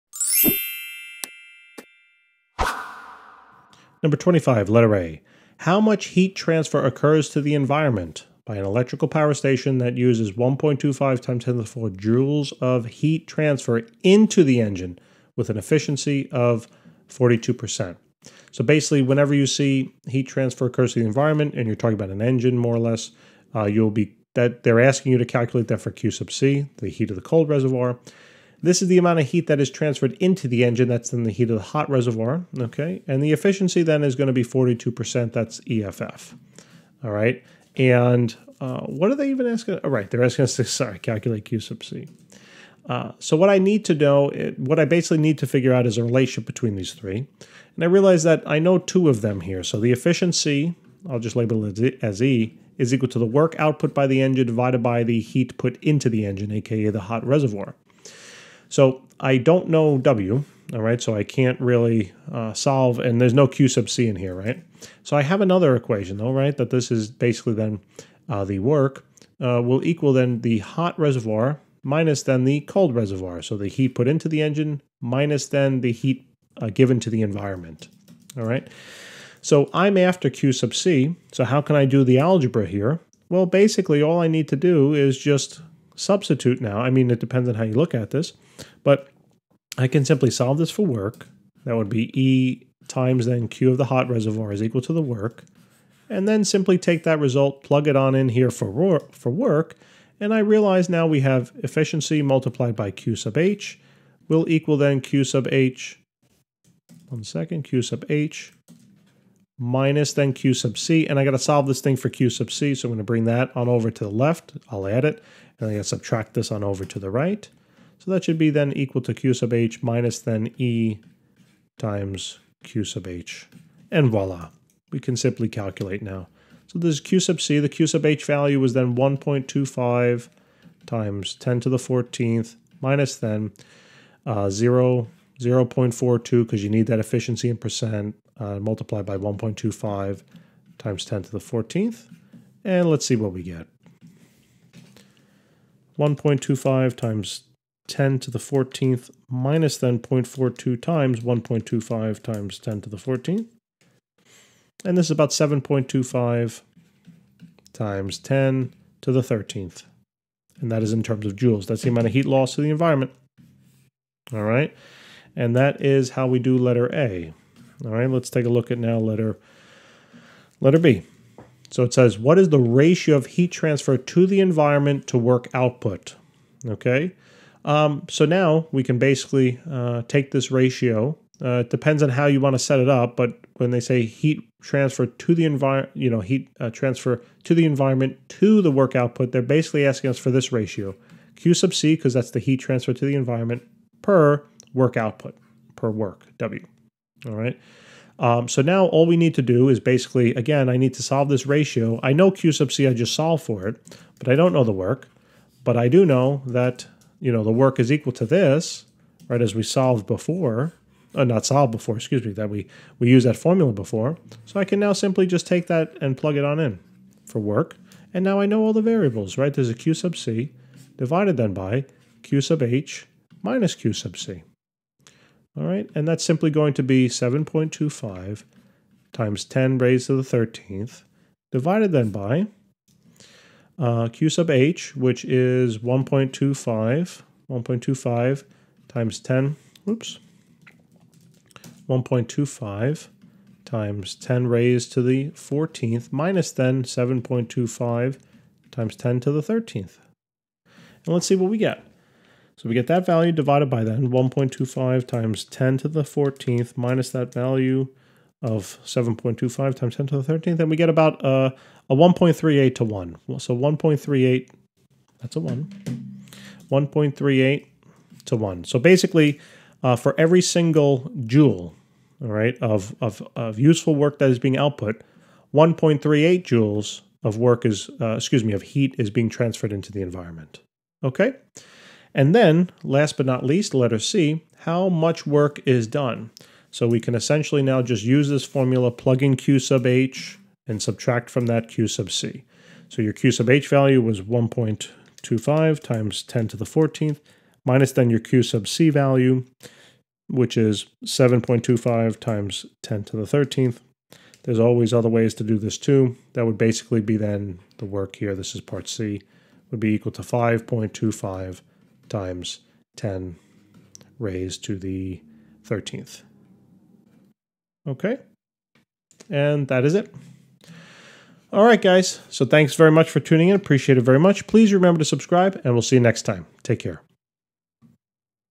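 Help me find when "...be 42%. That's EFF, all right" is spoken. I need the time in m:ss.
0:34.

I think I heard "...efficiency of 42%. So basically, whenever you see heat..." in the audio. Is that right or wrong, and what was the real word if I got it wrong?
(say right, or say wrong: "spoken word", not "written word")
right.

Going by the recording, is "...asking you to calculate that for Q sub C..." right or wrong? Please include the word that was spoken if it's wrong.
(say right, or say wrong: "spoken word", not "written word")
right.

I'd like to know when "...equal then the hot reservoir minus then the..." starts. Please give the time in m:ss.
1:09.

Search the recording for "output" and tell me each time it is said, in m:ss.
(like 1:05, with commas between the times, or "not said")
0:53, 2:55, 3:08, 3:14, 4:34.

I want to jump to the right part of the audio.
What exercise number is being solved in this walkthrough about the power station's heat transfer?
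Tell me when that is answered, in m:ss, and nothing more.
0:04.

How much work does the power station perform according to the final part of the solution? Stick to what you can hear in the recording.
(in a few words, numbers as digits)
5.25 x 10^13 J.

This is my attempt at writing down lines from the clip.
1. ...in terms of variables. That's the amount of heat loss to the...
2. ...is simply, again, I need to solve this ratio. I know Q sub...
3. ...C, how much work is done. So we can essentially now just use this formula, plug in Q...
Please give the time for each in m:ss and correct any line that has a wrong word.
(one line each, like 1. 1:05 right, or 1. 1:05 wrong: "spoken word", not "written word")
1. 2:40 wrong: "joules", not "variables"
2. 3:19 wrong: "basically", not "simply"
3. 4:43 right.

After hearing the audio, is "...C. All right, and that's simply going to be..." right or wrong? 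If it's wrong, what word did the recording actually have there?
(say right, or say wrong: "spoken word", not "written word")
right.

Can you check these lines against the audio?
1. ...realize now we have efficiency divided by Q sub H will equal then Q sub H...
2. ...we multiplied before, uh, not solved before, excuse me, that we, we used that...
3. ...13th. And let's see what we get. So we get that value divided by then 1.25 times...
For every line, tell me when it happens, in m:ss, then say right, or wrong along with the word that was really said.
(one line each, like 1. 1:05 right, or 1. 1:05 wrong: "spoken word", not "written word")
1. 1:40 wrong: "multiplied", not "divided"
2. 3:29 wrong: "solved", not "multiplied"
3. 4:09 right.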